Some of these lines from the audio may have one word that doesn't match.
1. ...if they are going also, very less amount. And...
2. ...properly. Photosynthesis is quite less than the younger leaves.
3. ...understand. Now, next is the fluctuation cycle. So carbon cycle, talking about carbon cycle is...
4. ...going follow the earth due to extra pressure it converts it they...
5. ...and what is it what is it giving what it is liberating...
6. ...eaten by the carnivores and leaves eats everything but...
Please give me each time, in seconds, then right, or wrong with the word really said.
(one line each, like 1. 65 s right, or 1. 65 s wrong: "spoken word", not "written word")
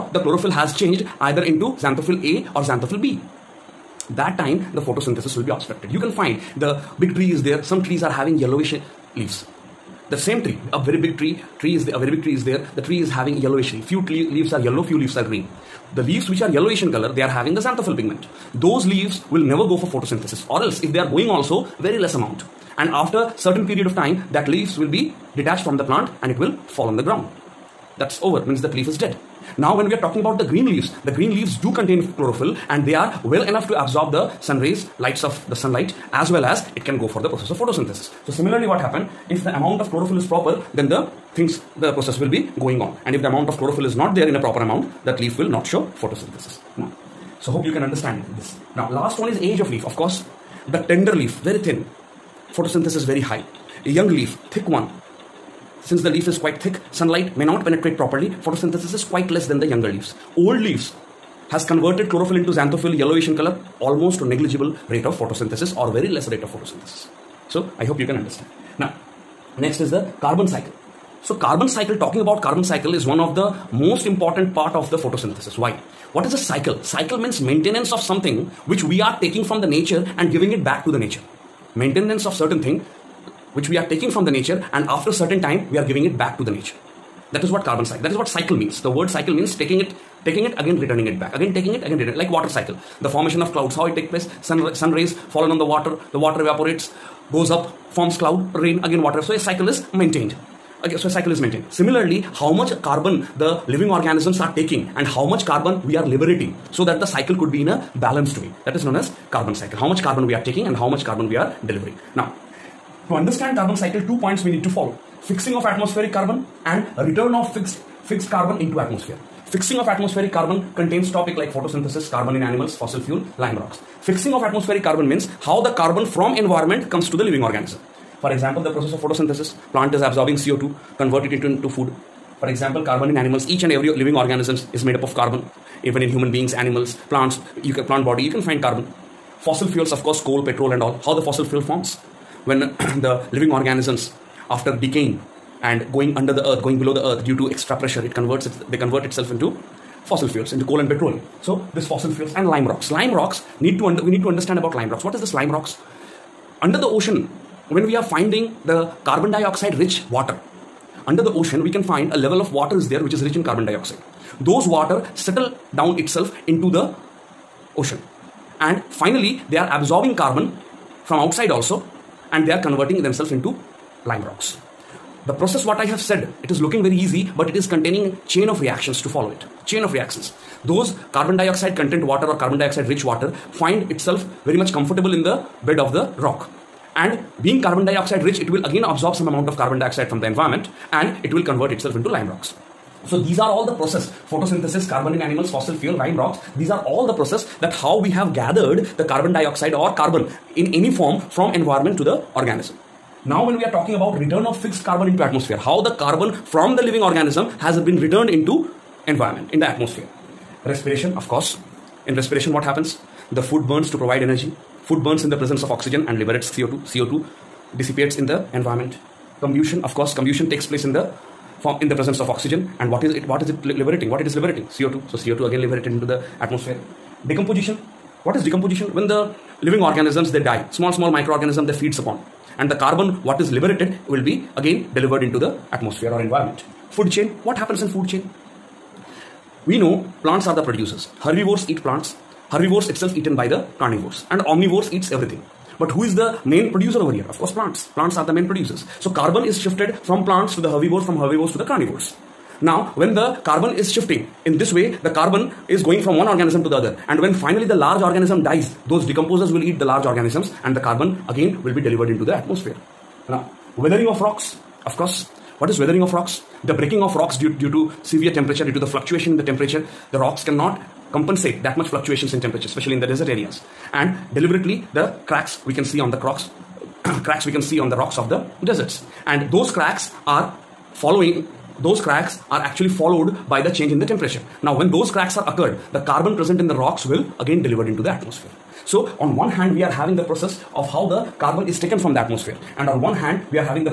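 1. 20 s right
2. 57 s right
3. 68 s wrong: "carbon", not "fluctuation"
4. 146 s wrong: "below", not "follow"
5. 222 s wrong: "liberating", not "giving"
6. 243 s wrong: "omnivores", not "leaves".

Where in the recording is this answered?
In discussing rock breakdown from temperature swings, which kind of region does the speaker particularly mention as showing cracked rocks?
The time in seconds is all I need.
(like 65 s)
273 s.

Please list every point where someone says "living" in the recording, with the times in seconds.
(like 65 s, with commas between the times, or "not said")
103 s, 127 s, 133 s, 143 s, 206 s, 229 s.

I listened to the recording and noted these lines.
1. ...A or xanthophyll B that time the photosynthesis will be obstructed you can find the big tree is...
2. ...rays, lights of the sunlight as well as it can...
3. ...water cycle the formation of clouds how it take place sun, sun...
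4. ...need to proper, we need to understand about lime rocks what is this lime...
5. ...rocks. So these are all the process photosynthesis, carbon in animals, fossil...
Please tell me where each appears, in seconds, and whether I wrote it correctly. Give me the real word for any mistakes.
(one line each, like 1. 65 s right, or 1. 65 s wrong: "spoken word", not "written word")
1. 2 s right
2. 34 s right
3. 92 s right
4. 153 s wrong: "under", not "proper"
5. 192 s right.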